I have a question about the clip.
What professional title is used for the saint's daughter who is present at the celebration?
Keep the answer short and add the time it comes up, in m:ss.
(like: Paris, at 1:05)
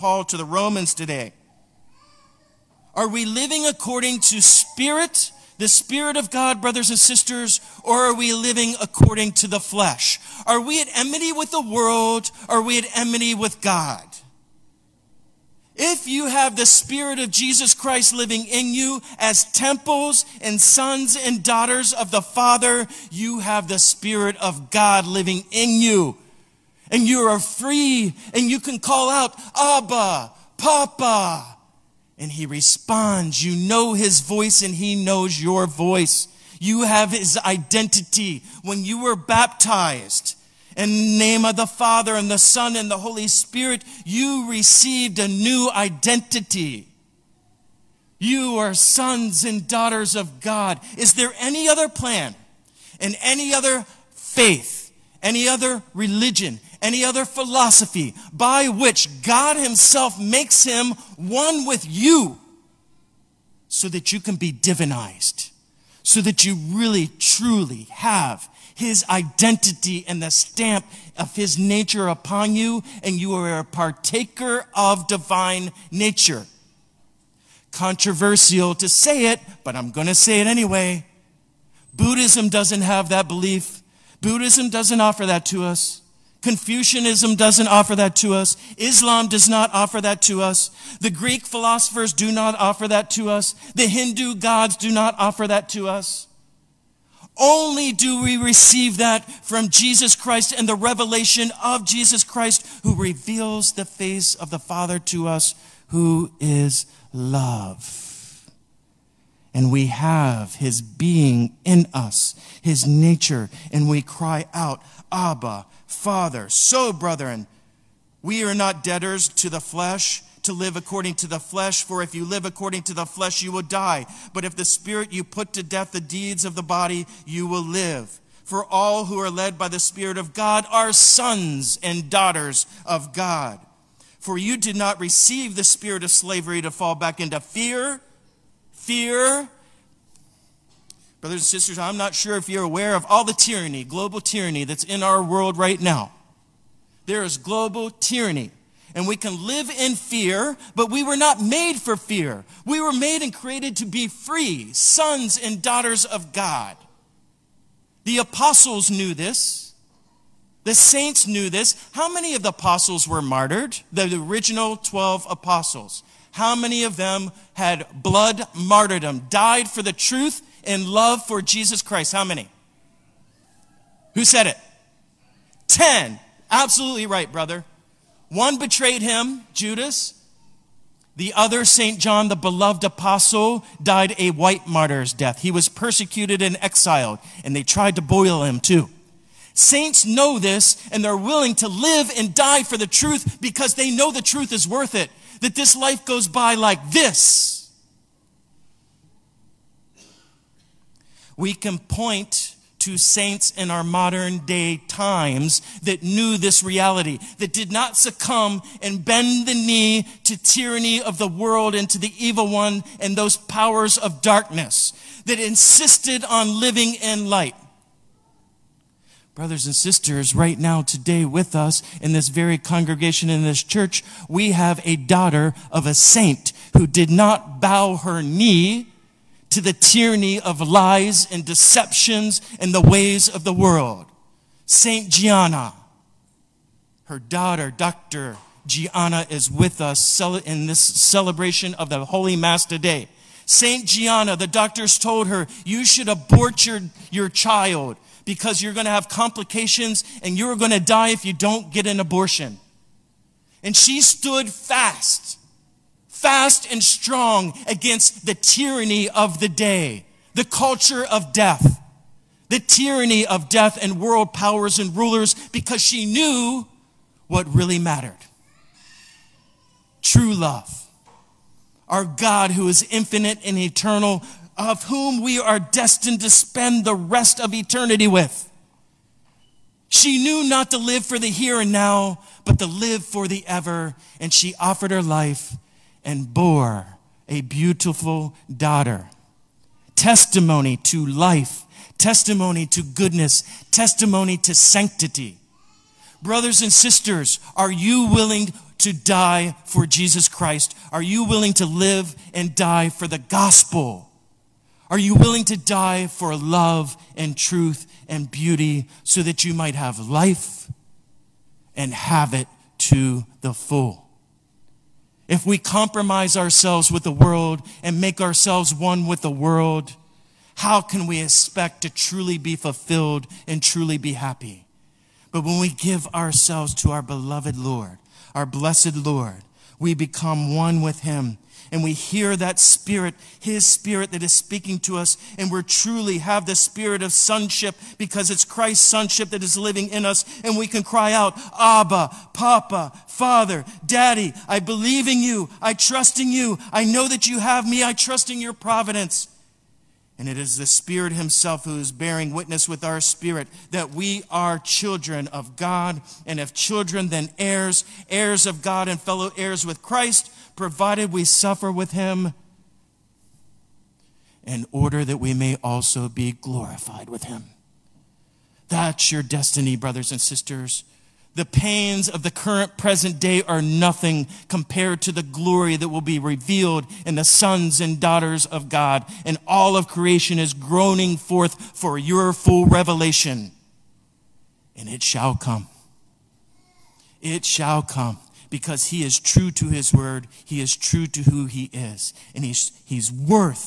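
Dr., at 3:57.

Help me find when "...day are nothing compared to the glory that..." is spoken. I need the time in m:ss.
6:13.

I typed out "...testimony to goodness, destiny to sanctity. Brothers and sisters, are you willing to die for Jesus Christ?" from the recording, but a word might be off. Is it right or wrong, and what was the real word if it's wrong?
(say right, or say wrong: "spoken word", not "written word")
wrong: "testimony", not "destiny".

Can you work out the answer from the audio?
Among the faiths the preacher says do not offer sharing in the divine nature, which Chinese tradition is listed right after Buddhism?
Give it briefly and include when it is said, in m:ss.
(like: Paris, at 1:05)
Confucianism, at 1:26.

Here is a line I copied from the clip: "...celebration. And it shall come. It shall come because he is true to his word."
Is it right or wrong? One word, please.
wrong.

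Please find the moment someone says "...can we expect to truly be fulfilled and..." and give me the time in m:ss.
5:20.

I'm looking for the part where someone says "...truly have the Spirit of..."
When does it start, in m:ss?
5:35.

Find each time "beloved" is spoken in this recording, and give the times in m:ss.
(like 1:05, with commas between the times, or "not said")
3:02, 5:27.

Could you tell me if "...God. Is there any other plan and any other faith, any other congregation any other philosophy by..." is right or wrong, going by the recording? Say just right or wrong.
wrong.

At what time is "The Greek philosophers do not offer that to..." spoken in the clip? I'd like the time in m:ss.
1:31.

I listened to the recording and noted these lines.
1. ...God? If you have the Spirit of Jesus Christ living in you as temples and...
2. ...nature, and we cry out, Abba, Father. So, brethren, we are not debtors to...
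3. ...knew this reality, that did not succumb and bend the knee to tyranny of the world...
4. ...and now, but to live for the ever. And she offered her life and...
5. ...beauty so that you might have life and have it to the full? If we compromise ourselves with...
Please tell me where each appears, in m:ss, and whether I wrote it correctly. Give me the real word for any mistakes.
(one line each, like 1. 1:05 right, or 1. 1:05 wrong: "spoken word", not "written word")
1. 0:13 right
2. 1:52 right
3. 3:26 right
4. 4:41 right
5. 5:08 right.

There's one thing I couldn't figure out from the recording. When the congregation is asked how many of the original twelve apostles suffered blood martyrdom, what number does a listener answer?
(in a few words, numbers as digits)
10.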